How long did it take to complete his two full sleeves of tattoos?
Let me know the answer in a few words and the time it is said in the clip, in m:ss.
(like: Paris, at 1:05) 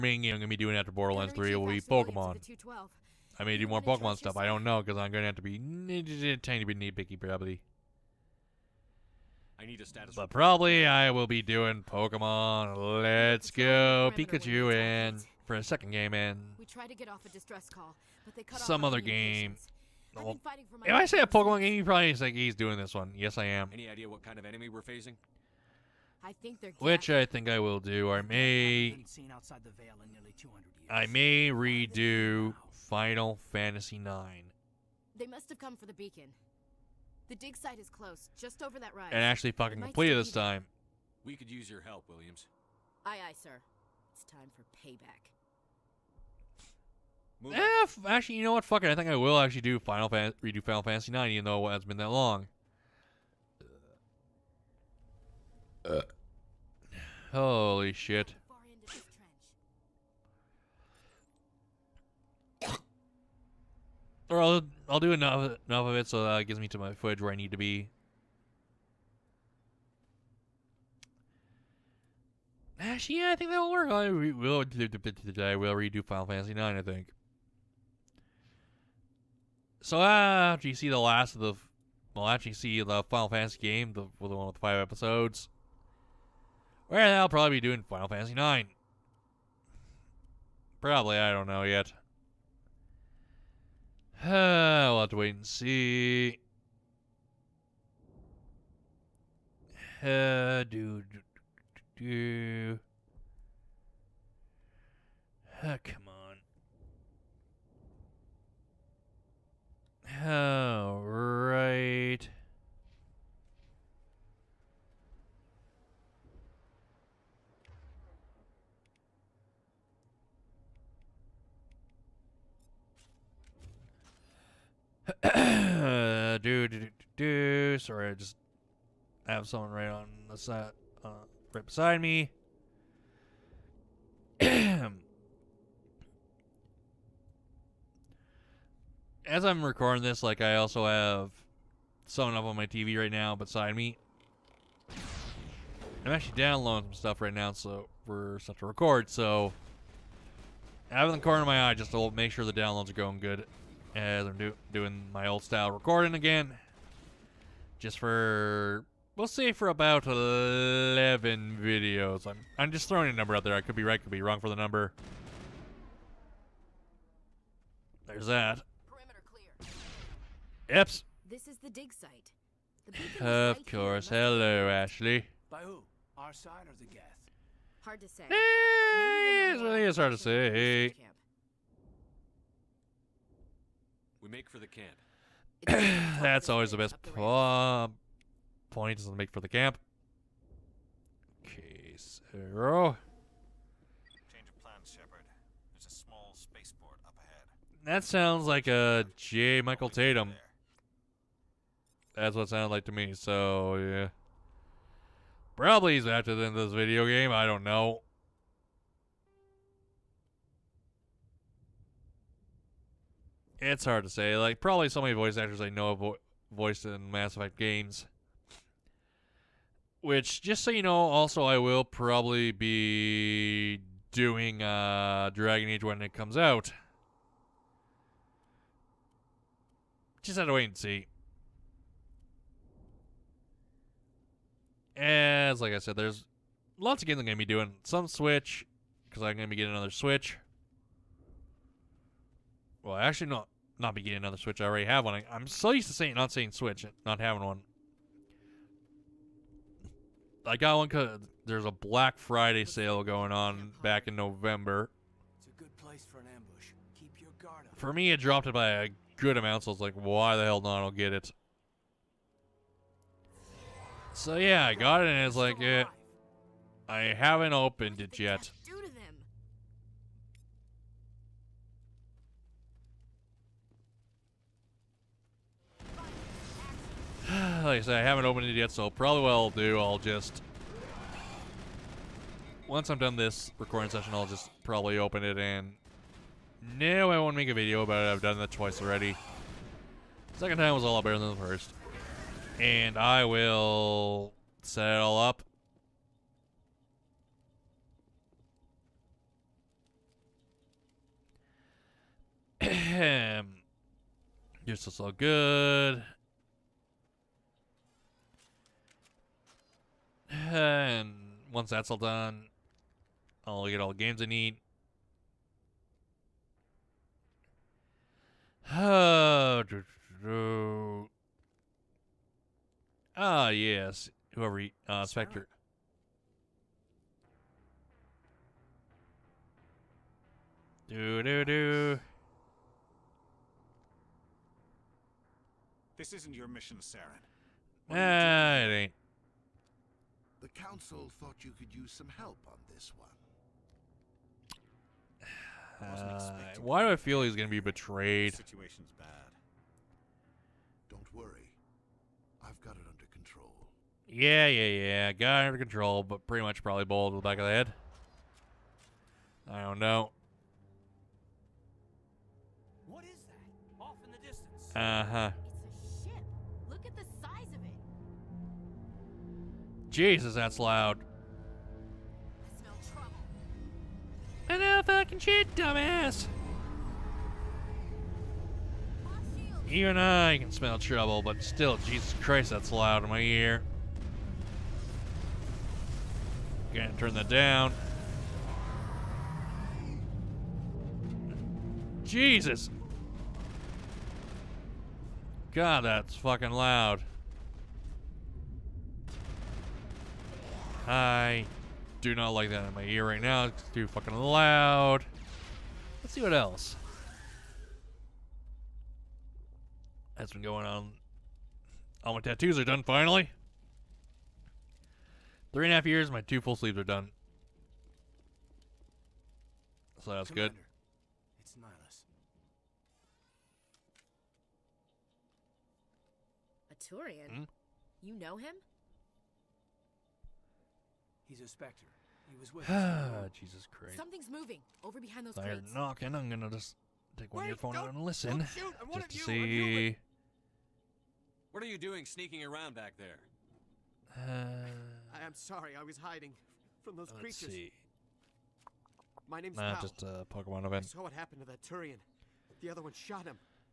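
Three and a half years, at 6:55.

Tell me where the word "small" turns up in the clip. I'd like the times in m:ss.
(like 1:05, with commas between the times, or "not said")
3:15.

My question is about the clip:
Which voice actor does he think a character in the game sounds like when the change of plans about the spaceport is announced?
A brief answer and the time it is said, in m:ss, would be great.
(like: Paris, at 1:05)
J. Michael Tatum, at 3:19.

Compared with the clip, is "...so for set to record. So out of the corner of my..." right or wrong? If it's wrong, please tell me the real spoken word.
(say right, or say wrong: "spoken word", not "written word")
right.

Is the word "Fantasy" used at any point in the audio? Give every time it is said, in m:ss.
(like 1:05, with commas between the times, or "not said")
0:33, 0:50, 1:16, 1:23, 1:28.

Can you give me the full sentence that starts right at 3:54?
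As like I said, there's lots of games I'm gonna be doing.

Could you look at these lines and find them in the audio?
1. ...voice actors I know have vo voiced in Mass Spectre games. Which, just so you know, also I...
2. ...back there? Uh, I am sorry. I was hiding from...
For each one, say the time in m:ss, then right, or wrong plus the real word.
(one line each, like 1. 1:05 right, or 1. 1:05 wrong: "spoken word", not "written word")
1. 3:35 wrong: "Effect", not "Spectre"
2. 7:22 right.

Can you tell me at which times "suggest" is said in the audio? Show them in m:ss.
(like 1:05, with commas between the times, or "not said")
not said.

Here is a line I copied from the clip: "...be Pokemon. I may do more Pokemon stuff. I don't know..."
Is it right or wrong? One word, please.
right.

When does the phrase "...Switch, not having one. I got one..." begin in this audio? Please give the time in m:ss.
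4:06.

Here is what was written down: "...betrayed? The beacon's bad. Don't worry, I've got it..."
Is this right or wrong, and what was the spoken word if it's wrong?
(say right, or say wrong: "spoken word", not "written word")
wrong: "situation", not "beacon".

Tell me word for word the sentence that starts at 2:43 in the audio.
I could be right, could be wrong for the number.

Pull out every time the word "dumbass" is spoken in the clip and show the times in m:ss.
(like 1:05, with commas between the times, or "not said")
6:15.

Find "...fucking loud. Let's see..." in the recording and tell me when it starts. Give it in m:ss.
6:43.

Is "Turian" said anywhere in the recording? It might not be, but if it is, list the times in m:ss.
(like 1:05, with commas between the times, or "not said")
7:06, 7:31.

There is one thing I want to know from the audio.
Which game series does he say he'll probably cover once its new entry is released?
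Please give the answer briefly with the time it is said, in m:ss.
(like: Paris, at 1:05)
Dragon Age, at 3:45.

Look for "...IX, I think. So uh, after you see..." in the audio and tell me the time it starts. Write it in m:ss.
1:16.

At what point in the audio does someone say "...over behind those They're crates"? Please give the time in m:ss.
7:14.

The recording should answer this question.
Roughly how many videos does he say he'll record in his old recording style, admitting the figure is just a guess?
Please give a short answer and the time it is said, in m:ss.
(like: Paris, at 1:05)
11, at 2:40.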